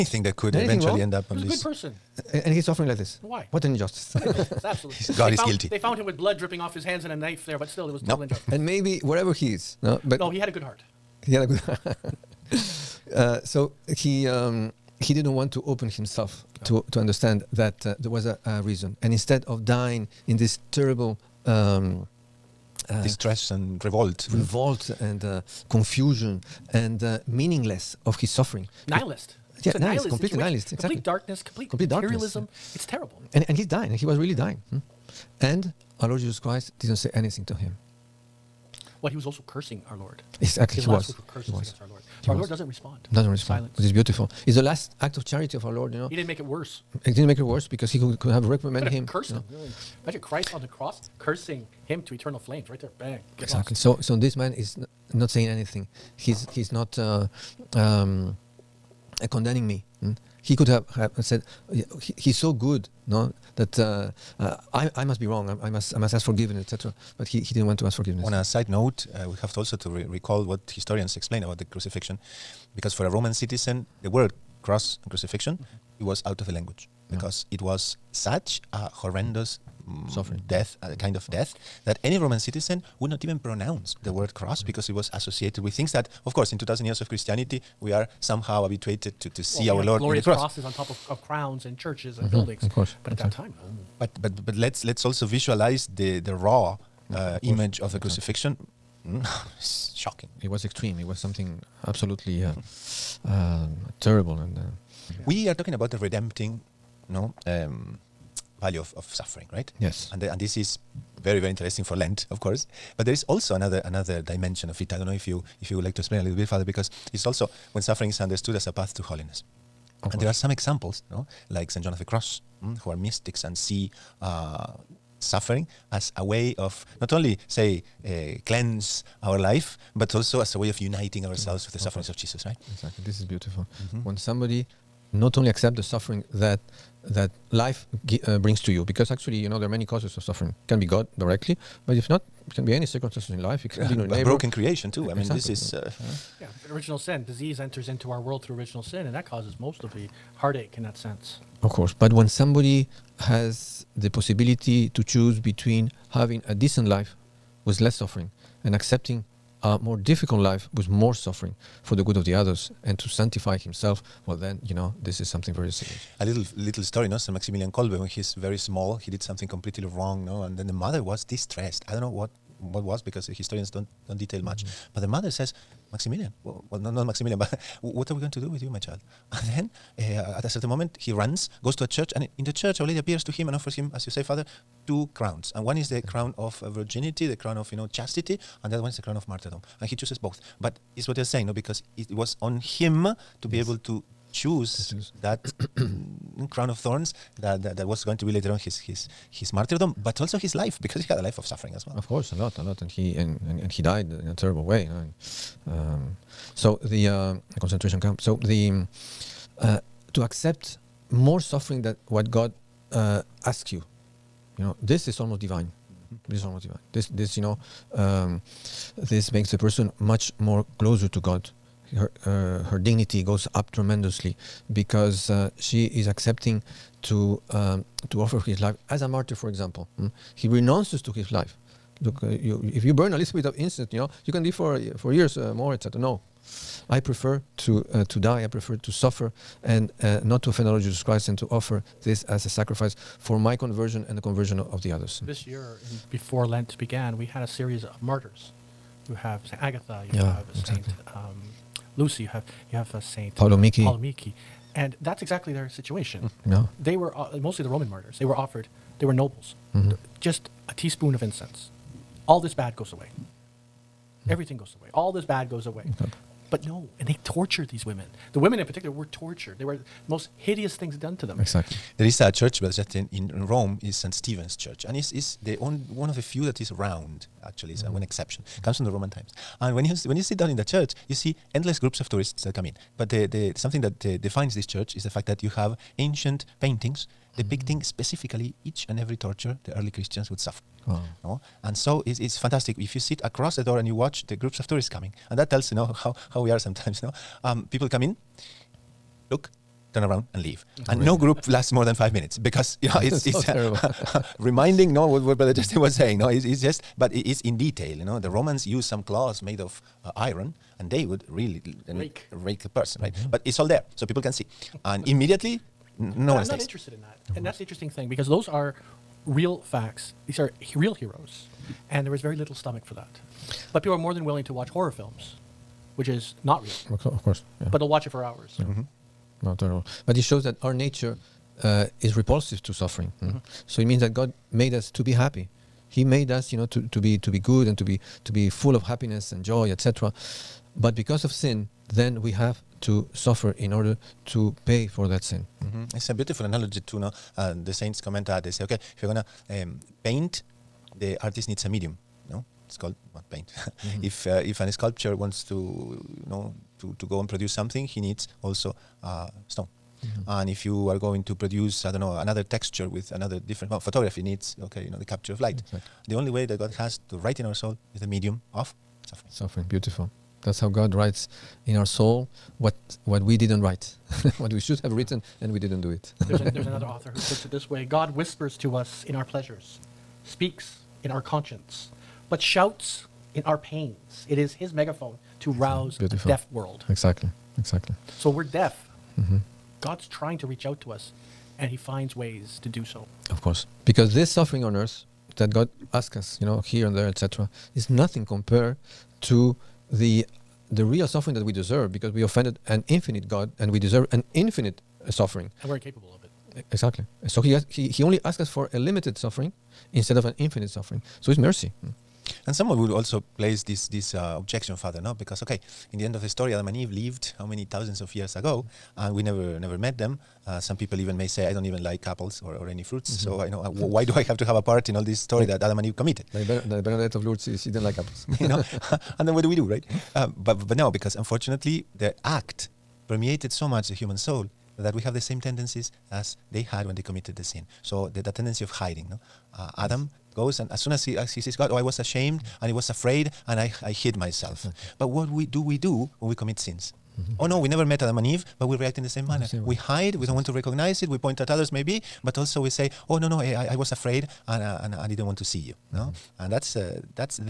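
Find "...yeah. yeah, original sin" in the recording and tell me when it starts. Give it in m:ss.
2:26.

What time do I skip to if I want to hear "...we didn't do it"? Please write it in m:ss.
6:15.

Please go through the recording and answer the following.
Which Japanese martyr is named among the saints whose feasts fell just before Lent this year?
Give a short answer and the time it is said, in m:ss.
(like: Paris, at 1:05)
Saint Paolo Miki, at 4:13.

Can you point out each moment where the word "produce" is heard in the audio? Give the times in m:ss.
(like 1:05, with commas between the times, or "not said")
5:57, 6:01.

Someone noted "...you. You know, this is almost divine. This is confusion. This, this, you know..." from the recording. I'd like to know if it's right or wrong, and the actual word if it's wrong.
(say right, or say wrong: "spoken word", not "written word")
wrong: "motivation", not "confusion".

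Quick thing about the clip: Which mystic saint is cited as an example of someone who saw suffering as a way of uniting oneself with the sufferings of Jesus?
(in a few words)
St. John of the Cross.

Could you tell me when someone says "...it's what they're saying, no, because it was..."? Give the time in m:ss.
3:10.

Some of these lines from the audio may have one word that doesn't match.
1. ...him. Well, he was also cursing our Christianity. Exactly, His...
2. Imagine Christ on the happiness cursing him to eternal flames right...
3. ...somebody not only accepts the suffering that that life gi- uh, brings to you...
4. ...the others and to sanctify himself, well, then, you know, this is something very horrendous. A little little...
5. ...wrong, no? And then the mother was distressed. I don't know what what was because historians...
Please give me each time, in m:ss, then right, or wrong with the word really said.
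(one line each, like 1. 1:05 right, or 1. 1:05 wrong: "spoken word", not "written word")
1. 0:37 wrong: "Lord", not "Christianity"
2. 0:50 wrong: "cross", not "happiness"
3. 2:14 right
4. 2:42 wrong: "serious", not "horrendous"
5. 2:49 right.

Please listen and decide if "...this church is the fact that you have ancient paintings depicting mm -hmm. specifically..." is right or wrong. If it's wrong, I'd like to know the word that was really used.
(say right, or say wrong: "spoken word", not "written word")
right.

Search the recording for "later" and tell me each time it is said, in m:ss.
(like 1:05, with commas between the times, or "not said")
3:18.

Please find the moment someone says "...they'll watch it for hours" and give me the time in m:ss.
5:27.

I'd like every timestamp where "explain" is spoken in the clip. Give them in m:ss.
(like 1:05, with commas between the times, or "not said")
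1:11, 1:56.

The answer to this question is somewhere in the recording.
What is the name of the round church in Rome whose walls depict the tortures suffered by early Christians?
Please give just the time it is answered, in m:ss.
4:33.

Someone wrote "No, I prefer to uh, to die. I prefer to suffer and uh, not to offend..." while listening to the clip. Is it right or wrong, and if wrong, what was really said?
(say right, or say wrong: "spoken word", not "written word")
right.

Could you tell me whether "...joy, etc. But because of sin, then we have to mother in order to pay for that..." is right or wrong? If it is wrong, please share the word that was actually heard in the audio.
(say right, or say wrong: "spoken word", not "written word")
wrong: "suffer", not "mother".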